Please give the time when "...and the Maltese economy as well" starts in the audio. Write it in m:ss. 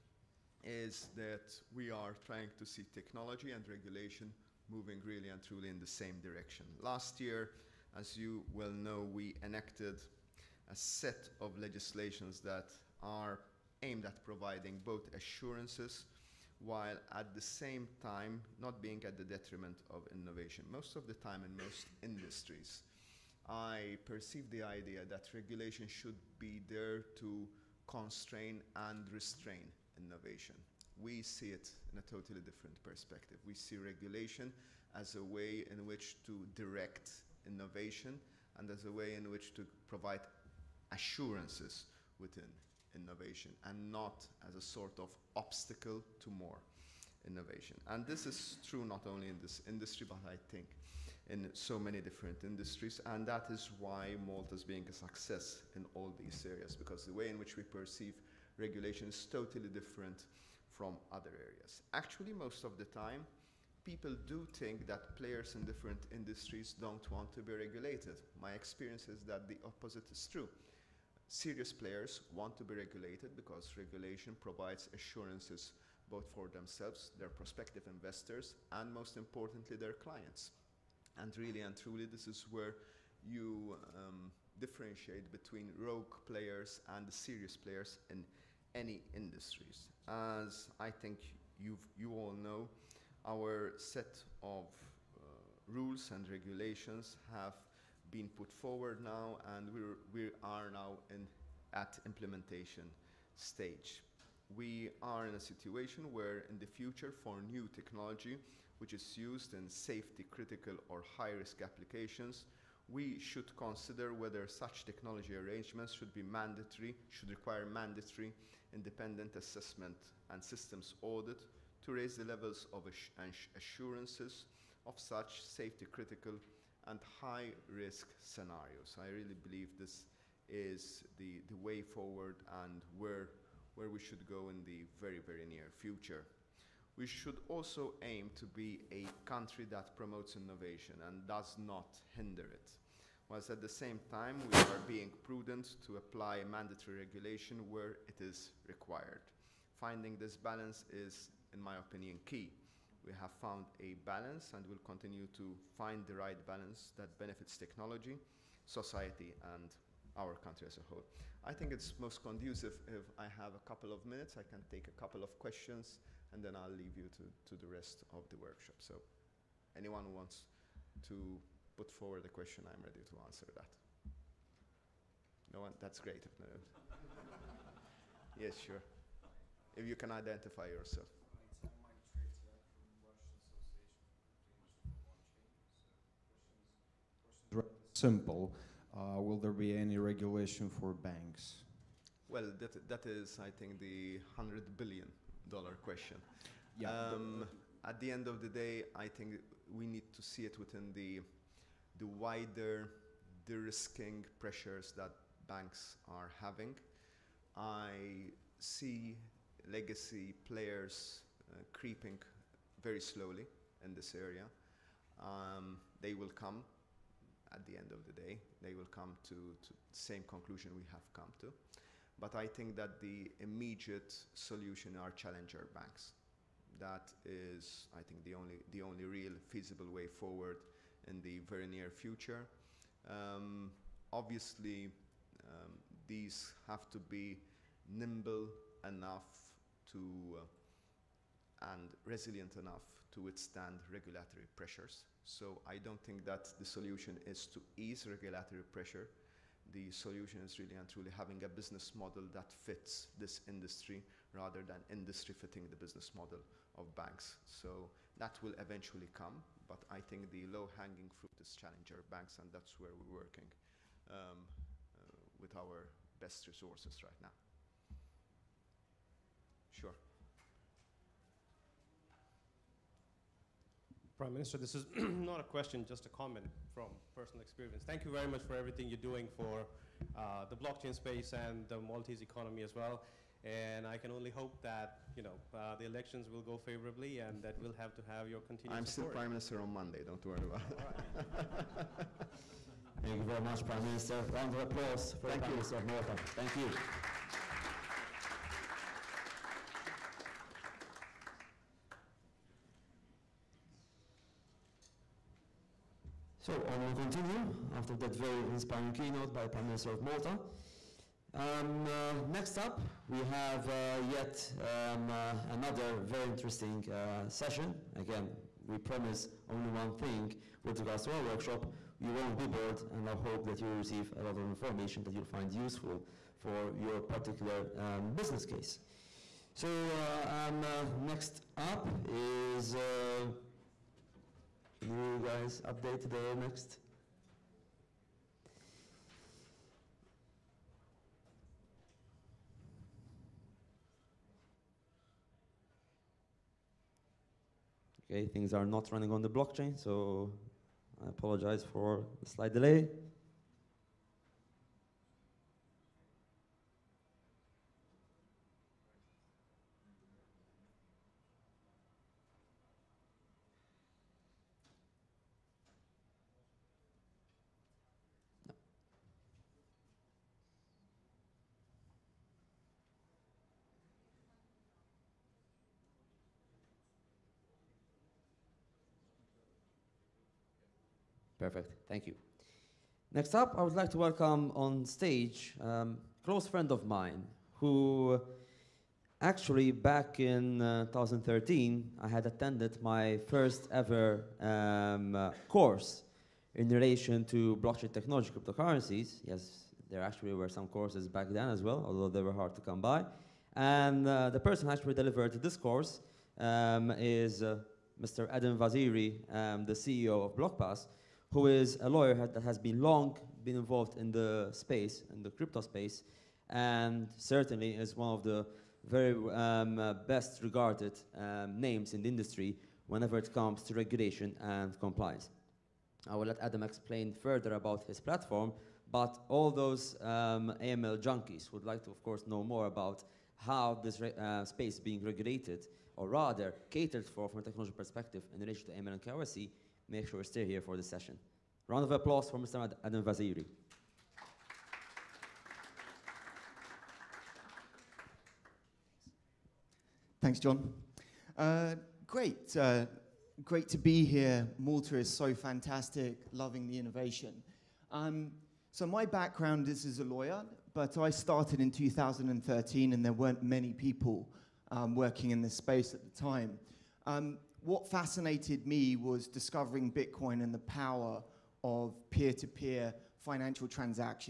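4:41.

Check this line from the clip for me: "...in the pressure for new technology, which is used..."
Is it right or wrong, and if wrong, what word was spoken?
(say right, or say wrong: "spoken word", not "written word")
wrong: "future", not "pressure".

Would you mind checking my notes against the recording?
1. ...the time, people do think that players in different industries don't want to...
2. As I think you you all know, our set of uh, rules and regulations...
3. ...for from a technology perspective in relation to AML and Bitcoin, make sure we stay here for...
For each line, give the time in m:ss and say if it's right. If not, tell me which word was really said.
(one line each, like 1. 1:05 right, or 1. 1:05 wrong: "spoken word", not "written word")
1. 1:02 right
2. 1:30 right
3. 7:17 wrong: "KYC", not "Bitcoin".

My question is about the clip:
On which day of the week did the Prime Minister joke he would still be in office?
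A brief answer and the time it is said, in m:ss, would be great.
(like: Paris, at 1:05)
Monday, at 4:49.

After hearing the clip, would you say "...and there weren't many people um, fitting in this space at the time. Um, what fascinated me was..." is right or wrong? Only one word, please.
wrong.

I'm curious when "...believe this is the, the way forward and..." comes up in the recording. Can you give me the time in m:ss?
2:09.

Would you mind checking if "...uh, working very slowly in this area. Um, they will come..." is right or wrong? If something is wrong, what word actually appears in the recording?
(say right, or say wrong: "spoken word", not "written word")
wrong: "creeping", not "working".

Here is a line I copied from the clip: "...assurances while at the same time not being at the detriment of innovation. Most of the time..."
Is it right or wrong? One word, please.
right.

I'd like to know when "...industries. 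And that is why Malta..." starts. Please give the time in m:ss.
0:52.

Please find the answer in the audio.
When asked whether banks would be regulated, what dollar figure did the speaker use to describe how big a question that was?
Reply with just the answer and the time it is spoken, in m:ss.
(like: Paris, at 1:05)
$100 billion, at 3:14.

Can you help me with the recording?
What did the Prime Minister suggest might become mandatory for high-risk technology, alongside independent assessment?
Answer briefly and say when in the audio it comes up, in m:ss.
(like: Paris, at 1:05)
Systems audit, at 2:00.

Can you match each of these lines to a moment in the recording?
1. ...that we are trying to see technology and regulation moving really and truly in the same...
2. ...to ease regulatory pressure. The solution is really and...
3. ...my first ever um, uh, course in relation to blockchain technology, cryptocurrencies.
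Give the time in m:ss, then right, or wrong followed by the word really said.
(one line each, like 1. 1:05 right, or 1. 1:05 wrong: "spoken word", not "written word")
1. 0:01 right
2. 4:07 right
3. 6:32 right.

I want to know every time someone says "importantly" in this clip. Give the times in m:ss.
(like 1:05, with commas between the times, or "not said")
1:19.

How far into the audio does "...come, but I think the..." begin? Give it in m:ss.
4:19.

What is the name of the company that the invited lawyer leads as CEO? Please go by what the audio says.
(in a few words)
BlockPass.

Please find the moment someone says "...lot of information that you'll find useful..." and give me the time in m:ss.
5:24.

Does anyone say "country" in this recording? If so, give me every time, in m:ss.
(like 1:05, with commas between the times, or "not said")
2:19, 2:40.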